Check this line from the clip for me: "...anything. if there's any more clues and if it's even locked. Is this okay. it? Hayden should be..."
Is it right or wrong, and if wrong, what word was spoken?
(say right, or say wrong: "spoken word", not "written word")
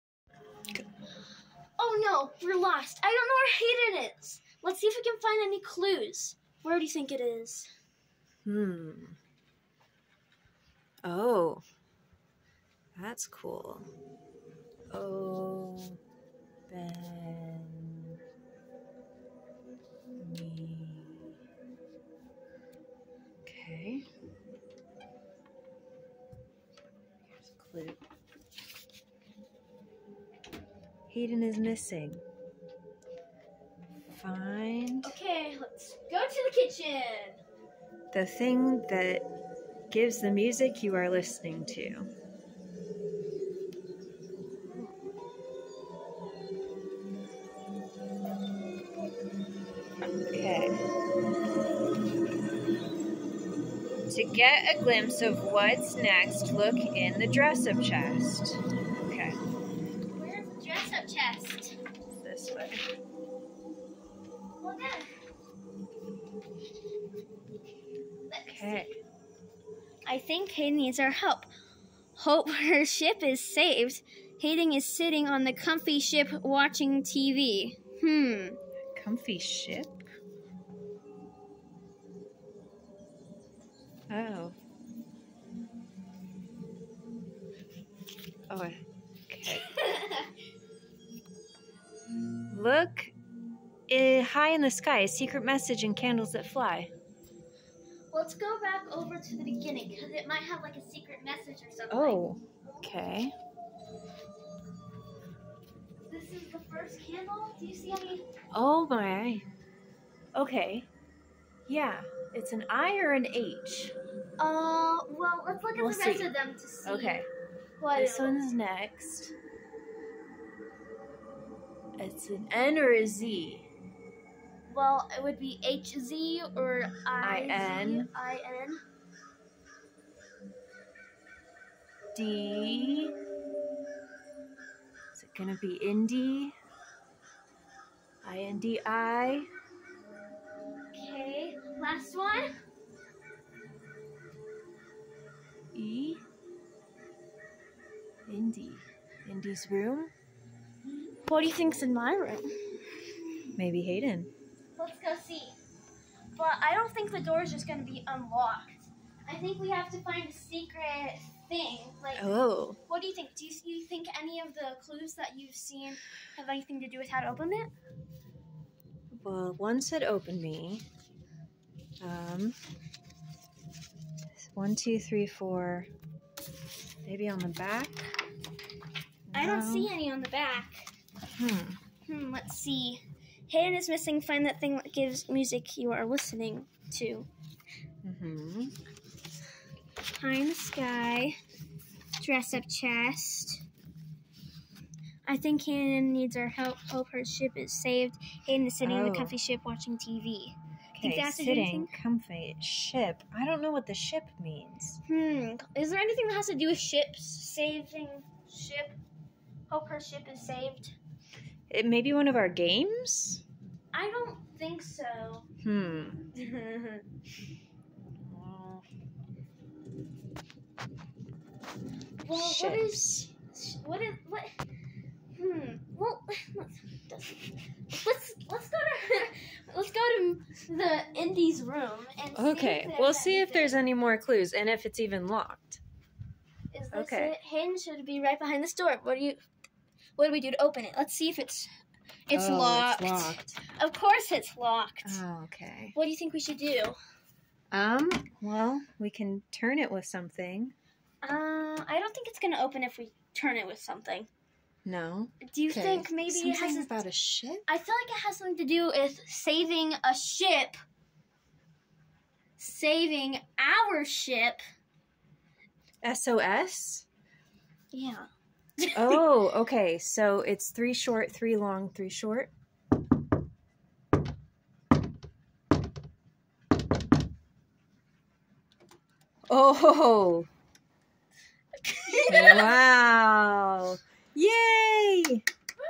right.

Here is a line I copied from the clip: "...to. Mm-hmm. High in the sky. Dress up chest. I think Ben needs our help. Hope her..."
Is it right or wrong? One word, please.
wrong.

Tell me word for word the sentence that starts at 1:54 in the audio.
Uh, well, let's look at we'll the rest see.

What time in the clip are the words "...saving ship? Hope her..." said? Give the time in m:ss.
3:27.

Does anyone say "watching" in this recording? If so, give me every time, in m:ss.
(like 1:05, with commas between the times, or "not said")
1:16, 3:19.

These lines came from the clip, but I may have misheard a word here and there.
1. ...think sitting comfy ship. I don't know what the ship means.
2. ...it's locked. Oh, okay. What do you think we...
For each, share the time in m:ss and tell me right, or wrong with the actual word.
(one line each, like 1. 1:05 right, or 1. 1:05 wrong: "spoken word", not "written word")
1. 3:21 right
2. 4:04 right.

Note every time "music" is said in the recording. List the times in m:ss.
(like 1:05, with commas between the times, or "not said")
0:40, 3:05.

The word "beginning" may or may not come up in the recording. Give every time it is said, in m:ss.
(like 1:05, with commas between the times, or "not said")
1:39.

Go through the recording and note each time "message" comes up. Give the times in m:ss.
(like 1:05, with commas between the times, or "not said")
1:35, 1:41.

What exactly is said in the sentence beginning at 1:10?
I think Kay needs our help.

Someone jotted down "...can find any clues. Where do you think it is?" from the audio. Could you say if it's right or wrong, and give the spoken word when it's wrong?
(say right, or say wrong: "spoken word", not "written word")
right.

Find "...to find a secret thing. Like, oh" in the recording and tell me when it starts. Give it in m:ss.
2:39.